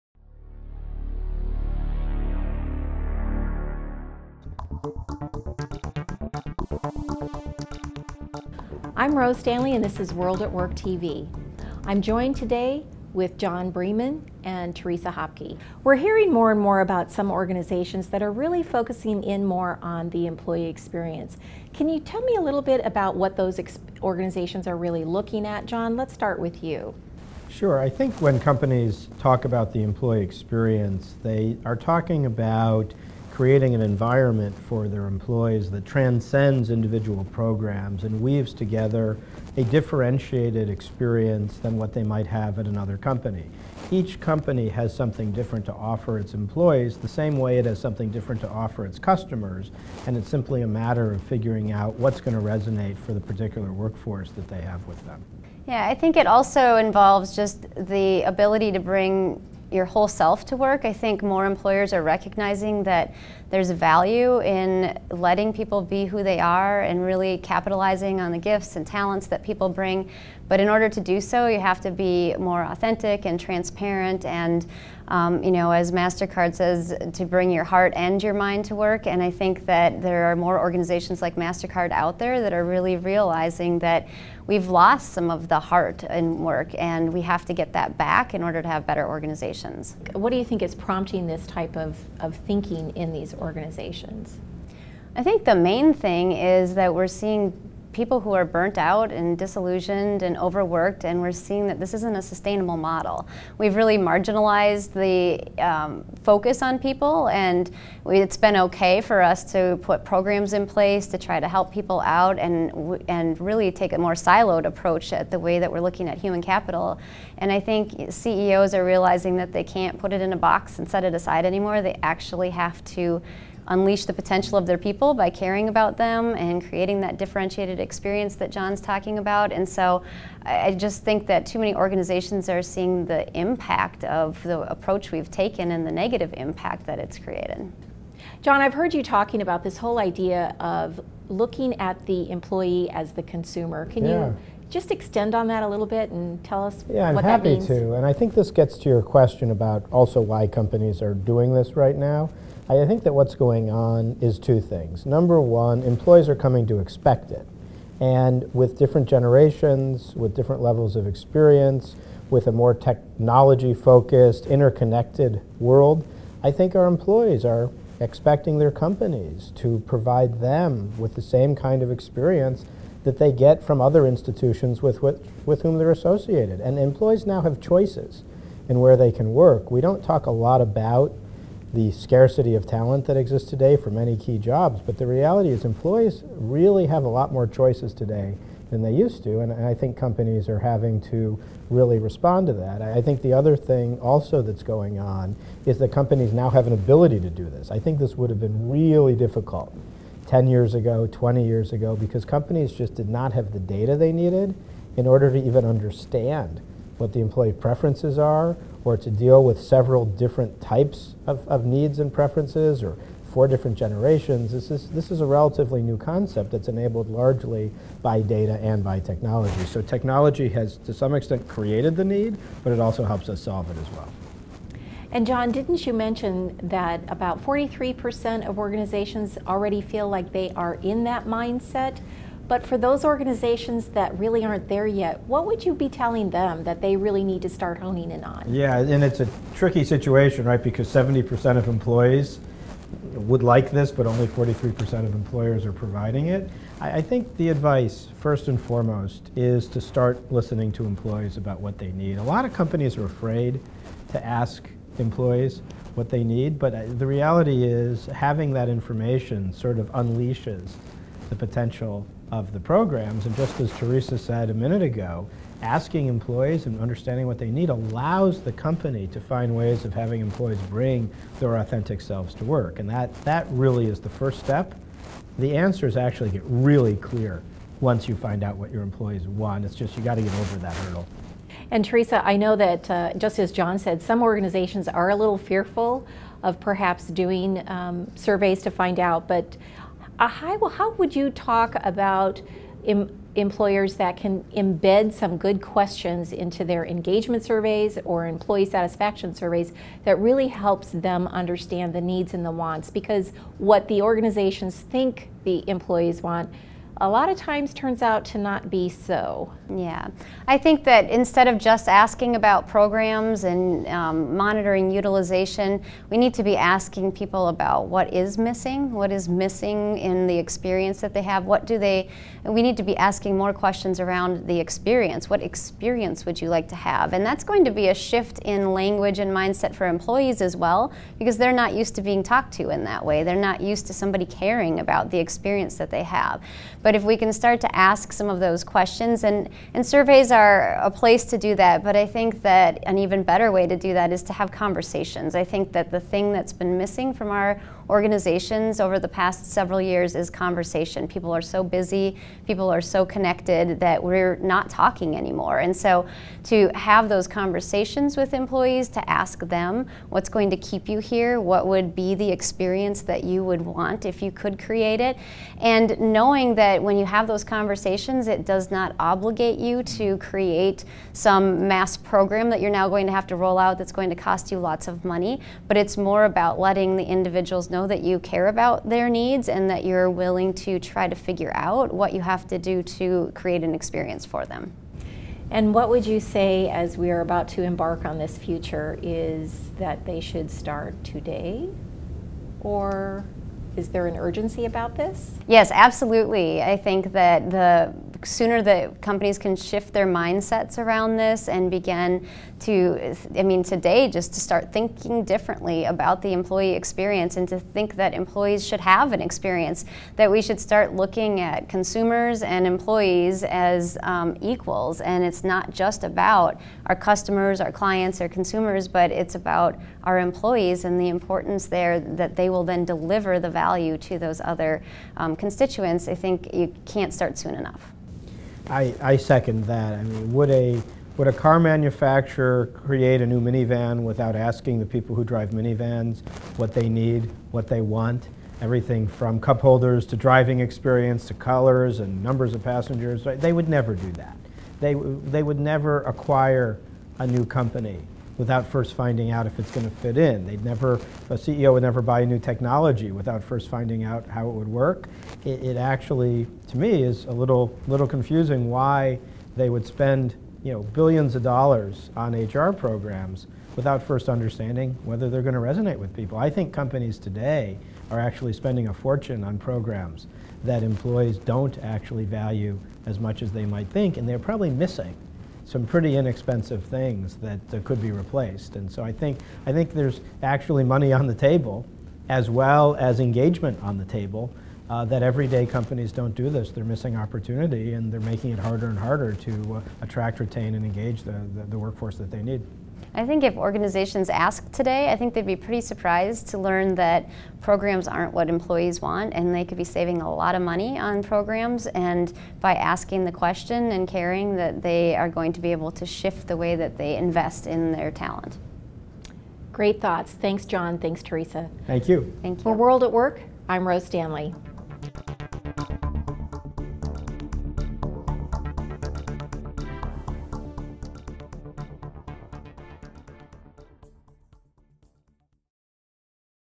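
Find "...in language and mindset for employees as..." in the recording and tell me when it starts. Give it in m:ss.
5:28.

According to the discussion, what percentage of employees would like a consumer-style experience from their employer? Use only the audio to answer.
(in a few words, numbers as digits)
70%.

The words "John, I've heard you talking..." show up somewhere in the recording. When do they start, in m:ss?
2:18.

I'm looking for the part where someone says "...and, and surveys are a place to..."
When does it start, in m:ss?
5:39.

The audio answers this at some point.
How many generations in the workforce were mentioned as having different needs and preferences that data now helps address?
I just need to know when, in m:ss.
3:33.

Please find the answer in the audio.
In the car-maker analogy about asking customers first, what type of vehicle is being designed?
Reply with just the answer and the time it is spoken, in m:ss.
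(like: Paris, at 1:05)
minivan, at 7:13.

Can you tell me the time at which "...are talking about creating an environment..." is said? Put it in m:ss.
0:31.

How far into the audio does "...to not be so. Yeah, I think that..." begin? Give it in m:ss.
5:08.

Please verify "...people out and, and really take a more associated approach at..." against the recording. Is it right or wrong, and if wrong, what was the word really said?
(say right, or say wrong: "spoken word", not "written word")
wrong: "siloed", not "associated".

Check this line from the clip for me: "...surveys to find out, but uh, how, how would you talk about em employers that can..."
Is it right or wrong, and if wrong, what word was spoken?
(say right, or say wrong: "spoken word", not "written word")
right.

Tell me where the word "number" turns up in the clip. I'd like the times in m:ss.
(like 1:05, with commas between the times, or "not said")
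2:35, 7:22.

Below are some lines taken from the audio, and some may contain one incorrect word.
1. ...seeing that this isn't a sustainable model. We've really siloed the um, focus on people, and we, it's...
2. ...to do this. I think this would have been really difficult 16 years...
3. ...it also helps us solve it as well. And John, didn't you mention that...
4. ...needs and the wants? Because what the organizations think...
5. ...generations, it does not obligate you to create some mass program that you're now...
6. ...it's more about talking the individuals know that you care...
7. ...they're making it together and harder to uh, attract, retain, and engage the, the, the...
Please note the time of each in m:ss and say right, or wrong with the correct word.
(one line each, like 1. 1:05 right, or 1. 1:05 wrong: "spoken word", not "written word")
1. 1:41 wrong: "marginalized", not "siloed"
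2. 3:17 wrong: "10", not "16"
3. 3:42 right
4. 5:02 right
5. 6:07 wrong: "conversations", not "generations"
6. 6:15 wrong: "letting", not "talking"
7. 8:08 wrong: "harder", not "together".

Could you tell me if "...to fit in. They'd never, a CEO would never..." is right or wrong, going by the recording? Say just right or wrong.
right.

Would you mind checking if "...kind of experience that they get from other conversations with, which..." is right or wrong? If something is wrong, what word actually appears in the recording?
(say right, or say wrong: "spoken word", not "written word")
wrong: "institutions", not "conversations".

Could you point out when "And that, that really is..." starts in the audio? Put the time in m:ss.
4:32.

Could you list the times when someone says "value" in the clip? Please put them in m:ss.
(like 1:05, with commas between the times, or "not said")
1:03, 7:03, 7:52.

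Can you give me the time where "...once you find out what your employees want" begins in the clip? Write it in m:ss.
4:37.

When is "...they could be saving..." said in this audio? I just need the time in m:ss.
8:19.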